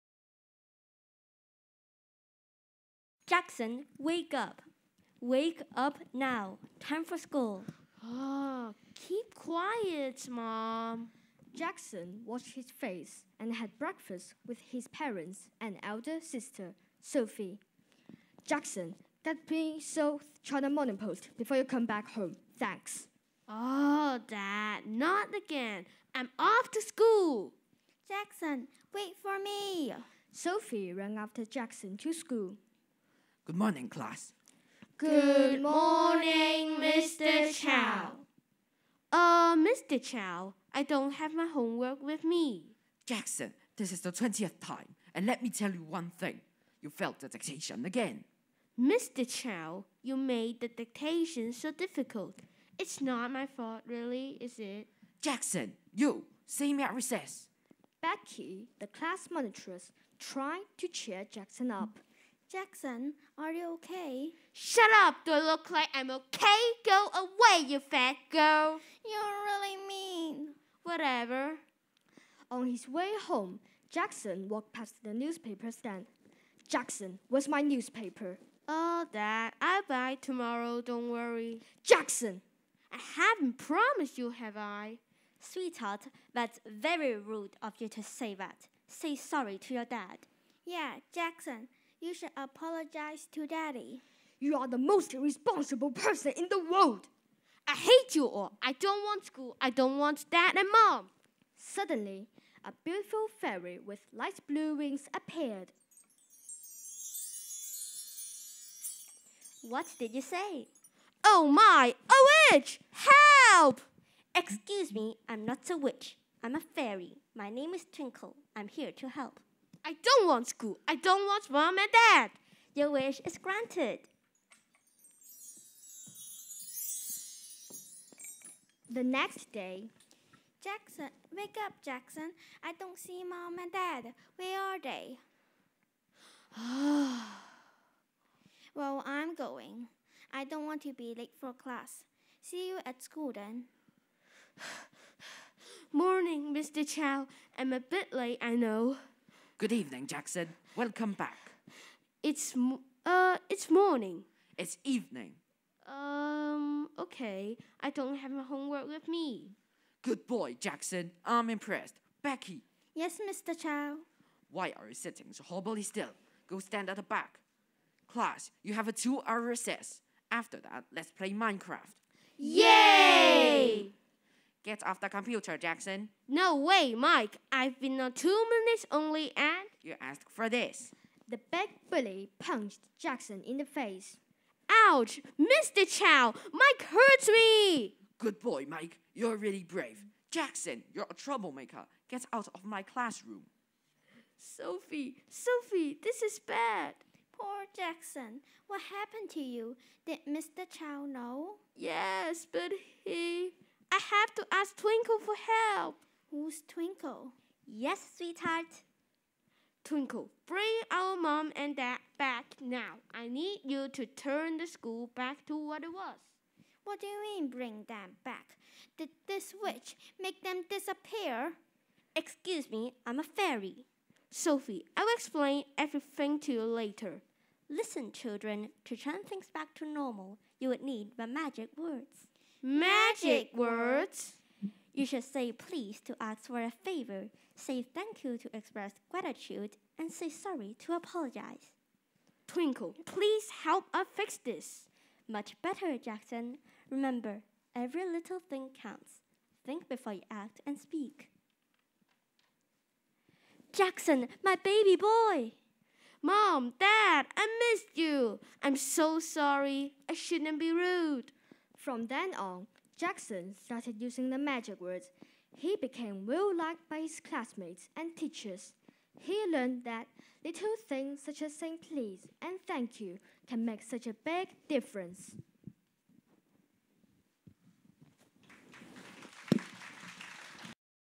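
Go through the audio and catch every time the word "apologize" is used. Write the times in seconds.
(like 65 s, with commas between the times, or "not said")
92 s, 240 s.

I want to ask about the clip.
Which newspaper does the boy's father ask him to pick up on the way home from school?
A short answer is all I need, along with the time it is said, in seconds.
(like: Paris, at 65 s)
South China Morning Post, at 19 s.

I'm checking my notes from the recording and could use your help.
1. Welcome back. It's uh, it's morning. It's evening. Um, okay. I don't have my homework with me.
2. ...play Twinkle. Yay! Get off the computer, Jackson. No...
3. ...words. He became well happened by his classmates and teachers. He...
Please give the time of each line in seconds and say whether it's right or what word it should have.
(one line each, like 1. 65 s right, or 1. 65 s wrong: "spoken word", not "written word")
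1. 150 s right
2. 171 s wrong: "Minecraft", not "Twinkle"
3. 264 s wrong: "liked", not "happened".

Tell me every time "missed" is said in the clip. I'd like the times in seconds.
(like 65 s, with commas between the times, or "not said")
257 s.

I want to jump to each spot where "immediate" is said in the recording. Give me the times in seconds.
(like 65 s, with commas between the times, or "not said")
not said.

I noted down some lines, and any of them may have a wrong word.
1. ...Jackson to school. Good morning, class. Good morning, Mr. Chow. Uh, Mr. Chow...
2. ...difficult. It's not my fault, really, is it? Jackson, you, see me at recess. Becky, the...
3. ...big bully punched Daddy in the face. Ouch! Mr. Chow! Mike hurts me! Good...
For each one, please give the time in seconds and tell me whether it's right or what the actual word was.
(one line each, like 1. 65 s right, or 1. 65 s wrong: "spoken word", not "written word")
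1. 31 s right
2. 51 s right
3. 181 s wrong: "Jackson", not "Daddy".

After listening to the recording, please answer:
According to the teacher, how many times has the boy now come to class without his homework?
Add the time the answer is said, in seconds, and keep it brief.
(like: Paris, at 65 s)
20th time, at 44 s.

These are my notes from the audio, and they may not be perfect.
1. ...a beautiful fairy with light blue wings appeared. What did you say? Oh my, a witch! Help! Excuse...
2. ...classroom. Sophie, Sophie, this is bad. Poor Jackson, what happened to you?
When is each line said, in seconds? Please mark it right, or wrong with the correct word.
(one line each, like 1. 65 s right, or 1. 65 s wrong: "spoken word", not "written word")
1. 102 s right
2. 192 s right.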